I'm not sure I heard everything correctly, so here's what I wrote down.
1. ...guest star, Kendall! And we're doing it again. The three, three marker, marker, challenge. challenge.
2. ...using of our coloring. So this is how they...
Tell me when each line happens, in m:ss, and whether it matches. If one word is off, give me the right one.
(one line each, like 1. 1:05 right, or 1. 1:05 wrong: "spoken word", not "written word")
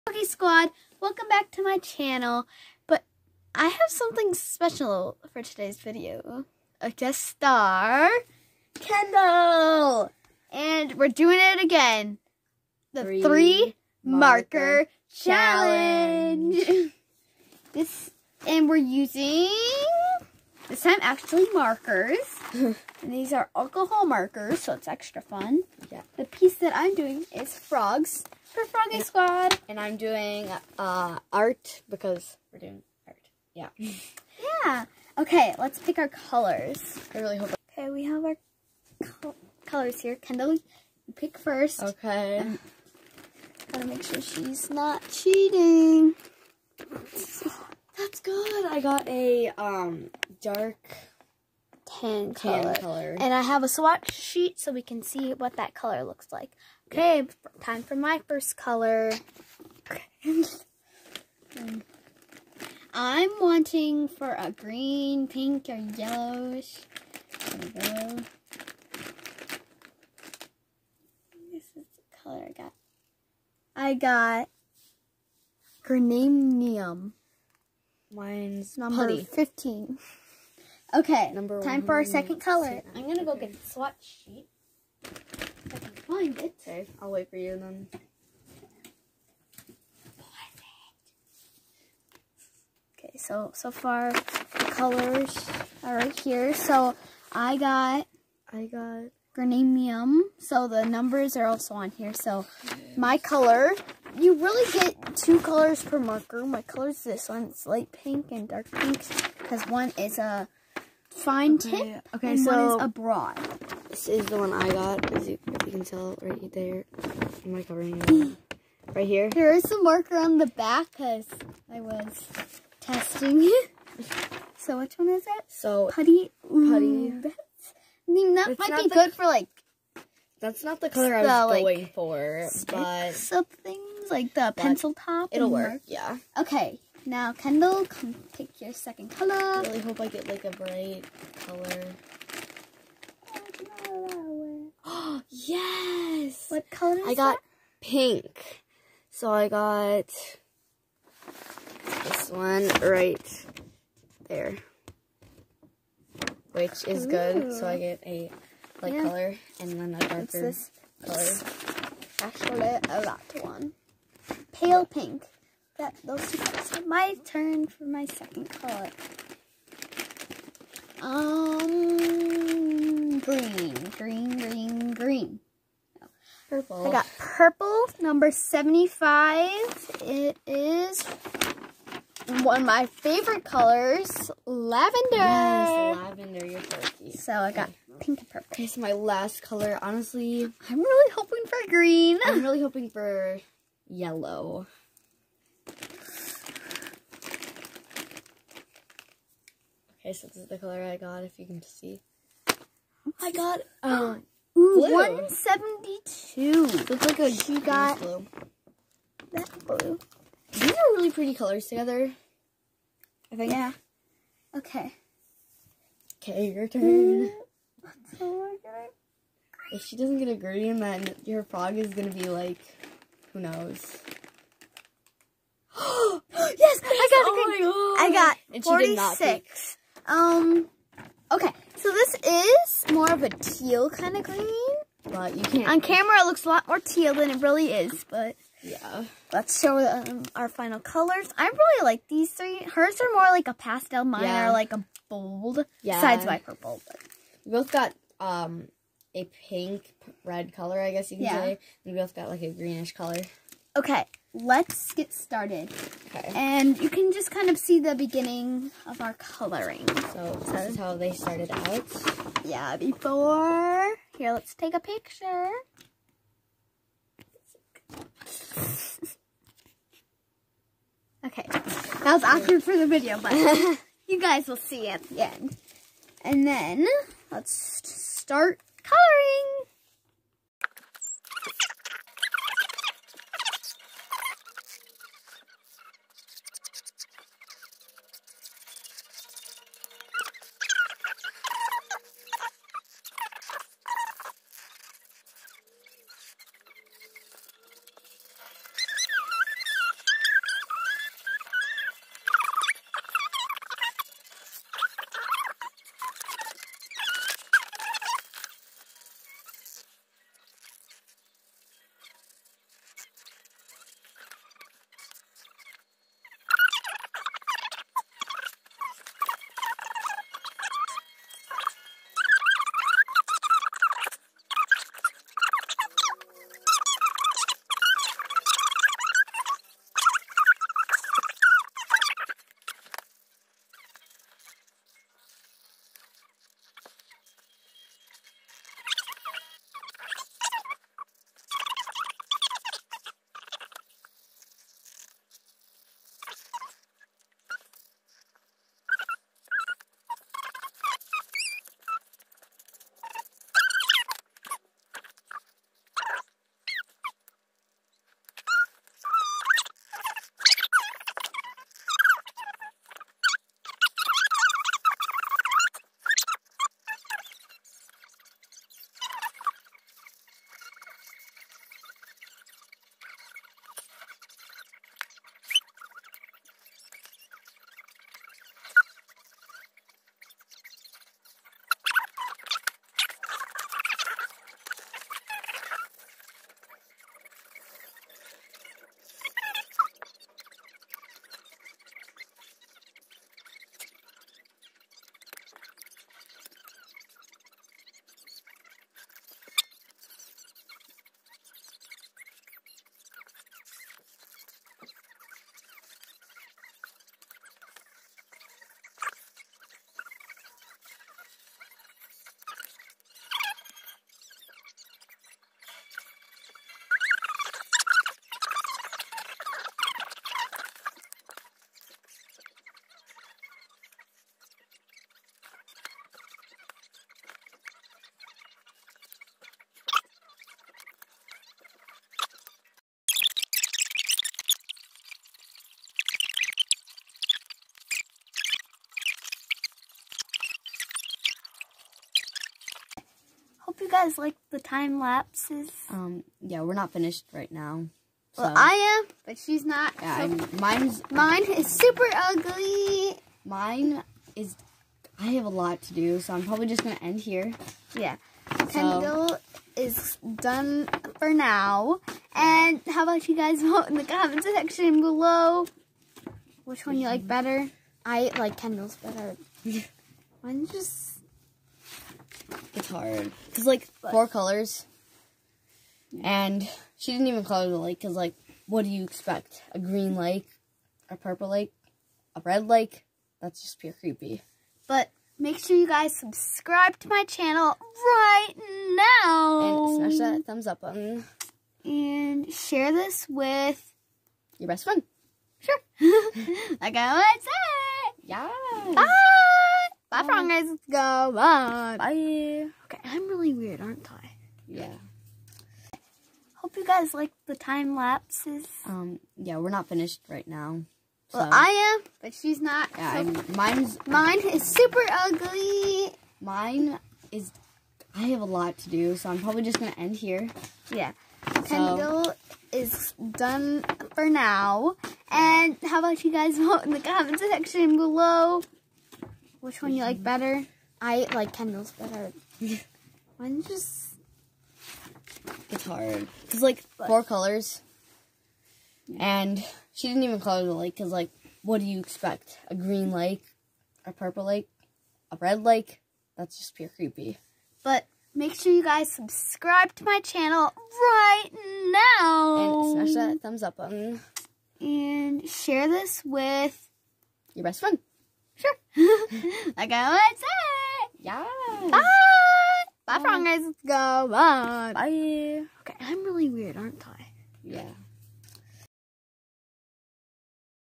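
1. 0:06 right
2. 4:17 wrong: "beginning", not "using".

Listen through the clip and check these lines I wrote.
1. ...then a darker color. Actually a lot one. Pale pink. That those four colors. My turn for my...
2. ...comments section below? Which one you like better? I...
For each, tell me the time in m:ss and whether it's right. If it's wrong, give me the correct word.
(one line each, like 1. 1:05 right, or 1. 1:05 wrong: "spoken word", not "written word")
1. 2:39 wrong: "two", not "four"
2. 7:44 right.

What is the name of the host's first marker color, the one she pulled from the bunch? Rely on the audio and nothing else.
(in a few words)
Grananium.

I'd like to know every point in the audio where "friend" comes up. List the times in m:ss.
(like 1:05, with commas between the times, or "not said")
8:14, 9:17.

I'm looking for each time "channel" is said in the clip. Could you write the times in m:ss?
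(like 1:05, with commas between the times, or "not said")
0:01, 8:07, 9:10.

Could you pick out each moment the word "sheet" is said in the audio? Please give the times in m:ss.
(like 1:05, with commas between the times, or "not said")
0:54, 1:24.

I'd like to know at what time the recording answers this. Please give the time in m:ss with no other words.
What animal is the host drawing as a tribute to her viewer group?
0:27.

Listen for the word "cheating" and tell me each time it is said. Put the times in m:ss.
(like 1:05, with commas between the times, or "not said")
0:45.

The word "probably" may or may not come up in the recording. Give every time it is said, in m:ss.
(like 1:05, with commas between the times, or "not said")
7:36, 8:39.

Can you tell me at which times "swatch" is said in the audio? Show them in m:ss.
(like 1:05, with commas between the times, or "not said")
0:53, 1:23.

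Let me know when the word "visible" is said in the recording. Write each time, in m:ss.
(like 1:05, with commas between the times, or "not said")
not said.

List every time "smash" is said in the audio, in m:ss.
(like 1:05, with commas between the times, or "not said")
8:10, 9:13.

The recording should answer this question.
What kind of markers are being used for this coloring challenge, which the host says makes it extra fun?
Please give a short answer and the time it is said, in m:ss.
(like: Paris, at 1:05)
Alcohol markers, at 0:23.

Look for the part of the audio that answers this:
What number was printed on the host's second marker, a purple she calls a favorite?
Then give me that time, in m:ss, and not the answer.
2:58.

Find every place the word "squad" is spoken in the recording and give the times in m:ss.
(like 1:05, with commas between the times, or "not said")
0:00, 0:29.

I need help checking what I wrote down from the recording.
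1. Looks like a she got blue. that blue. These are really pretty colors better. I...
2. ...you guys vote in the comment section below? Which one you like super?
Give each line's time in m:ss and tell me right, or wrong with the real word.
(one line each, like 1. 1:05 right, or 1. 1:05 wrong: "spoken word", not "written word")
1. 3:26 wrong: "together", not "better"
2. 8:46 wrong: "better", not "super".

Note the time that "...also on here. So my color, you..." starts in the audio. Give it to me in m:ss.
1:41.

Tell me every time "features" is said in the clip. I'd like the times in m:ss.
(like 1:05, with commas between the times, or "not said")
not said.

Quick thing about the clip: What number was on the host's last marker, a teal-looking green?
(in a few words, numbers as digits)
46.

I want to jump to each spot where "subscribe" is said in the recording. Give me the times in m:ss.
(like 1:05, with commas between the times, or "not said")
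8:06, 9:09.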